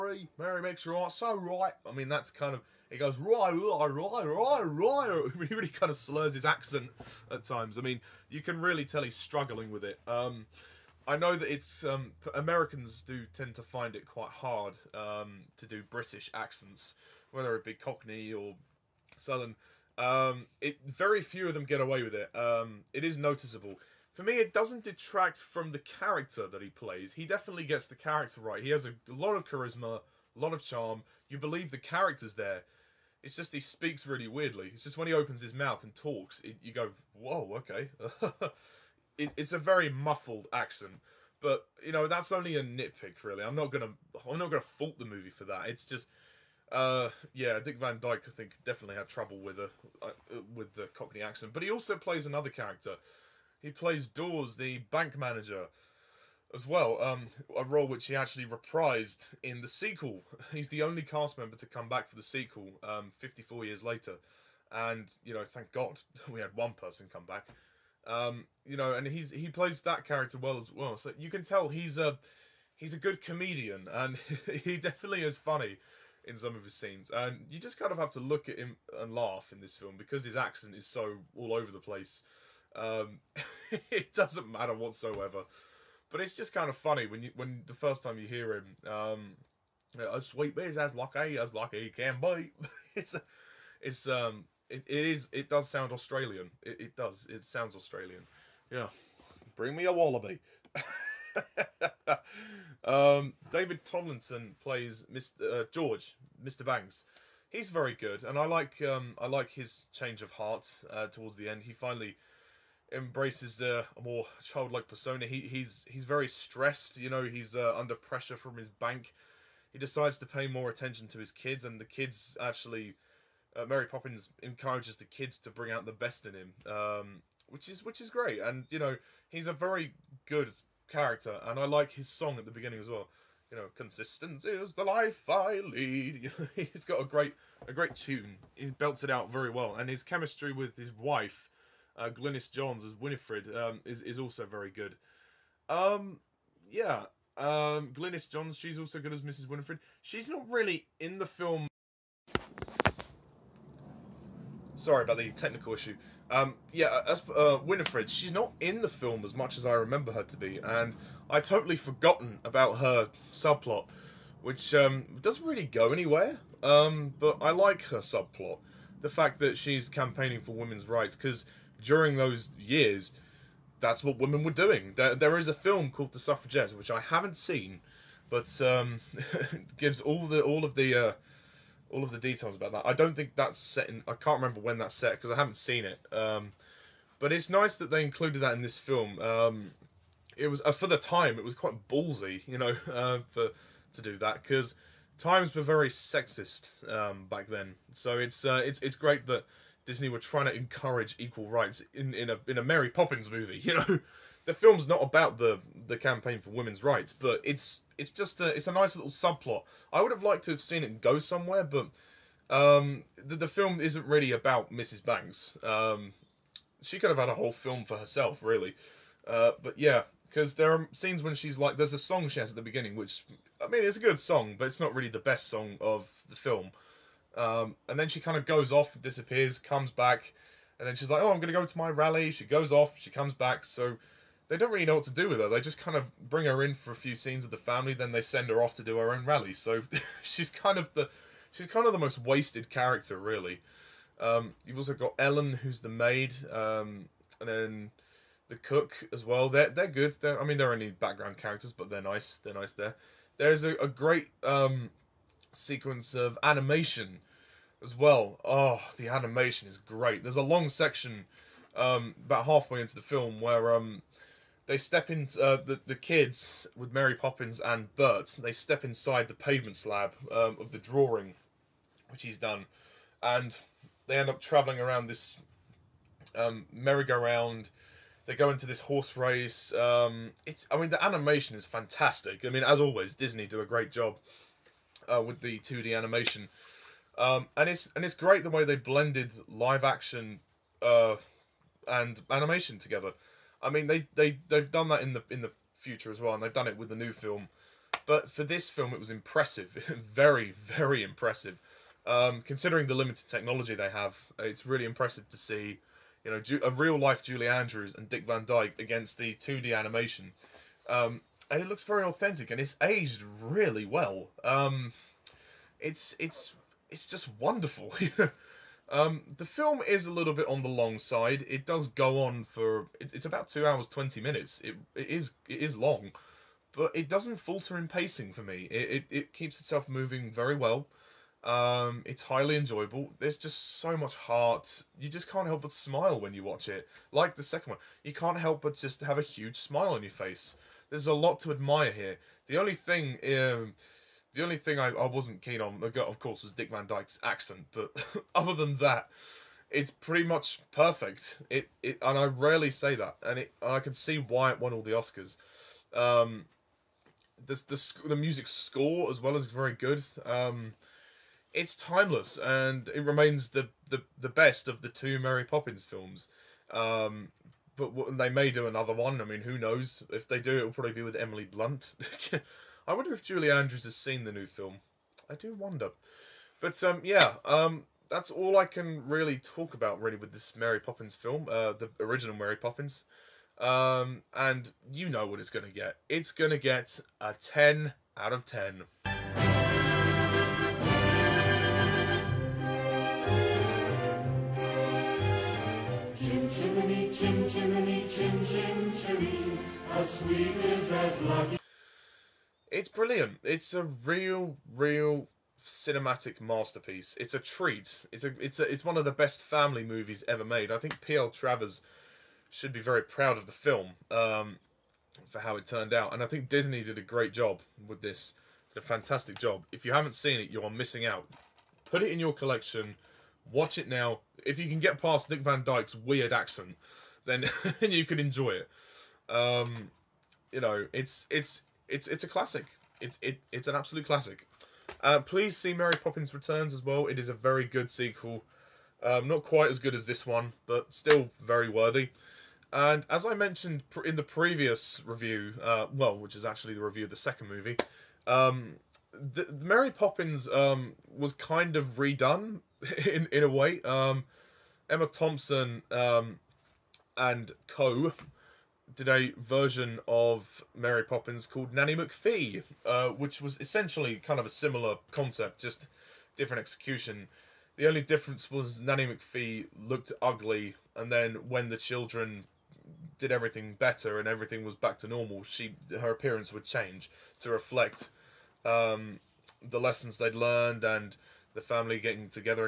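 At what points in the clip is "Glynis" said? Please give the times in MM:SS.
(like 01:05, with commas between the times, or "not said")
02:22, 02:27.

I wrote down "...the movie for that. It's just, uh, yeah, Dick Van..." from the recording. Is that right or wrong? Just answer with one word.
right.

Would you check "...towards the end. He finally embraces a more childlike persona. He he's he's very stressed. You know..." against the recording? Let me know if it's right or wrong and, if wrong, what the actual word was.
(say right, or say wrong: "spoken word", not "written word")
right.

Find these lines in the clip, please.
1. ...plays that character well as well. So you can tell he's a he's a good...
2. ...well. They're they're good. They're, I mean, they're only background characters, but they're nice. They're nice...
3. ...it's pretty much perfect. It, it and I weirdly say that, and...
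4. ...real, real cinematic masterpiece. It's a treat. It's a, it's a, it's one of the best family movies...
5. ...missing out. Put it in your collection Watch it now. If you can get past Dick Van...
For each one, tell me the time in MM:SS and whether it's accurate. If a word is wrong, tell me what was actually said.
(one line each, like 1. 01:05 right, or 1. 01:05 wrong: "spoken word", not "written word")
1. 01:09 right
2. 04:09 right
3. 05:49 wrong: "rarely", not "weirdly"
4. 06:44 right
5. 07:00 right.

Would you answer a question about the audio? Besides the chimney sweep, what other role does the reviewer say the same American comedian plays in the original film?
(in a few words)
Dawes, the bank manager.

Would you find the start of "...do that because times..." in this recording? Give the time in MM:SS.
03:14.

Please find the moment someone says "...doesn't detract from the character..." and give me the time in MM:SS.
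00:24.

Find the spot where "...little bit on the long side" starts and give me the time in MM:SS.
05:20.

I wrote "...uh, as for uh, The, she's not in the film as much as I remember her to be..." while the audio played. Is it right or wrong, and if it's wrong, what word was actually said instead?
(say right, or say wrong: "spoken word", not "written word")
wrong: "Winifred", not "The".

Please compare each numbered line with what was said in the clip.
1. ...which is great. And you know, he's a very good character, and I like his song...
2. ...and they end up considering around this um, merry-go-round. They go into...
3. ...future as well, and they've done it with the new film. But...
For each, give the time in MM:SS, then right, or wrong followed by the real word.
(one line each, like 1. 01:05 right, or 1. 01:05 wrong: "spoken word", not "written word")
1. 02:07 right
2. 04:33 wrong: "traveling", not "considering"
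3. 04:55 right.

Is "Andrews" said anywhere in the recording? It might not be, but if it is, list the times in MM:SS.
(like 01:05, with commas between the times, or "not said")
05:07, 06:13.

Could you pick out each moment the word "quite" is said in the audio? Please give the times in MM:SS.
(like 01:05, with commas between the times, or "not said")
00:14, 03:11, 07:19.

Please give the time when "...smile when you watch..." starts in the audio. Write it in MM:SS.
05:35.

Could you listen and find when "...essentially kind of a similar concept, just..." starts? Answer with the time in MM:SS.
07:43.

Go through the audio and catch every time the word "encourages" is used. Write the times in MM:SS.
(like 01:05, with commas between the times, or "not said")
02:04, 03:20.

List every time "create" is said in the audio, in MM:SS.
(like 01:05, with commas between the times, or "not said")
not said.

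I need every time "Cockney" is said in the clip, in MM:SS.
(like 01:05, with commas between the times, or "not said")
00:17, 00:50.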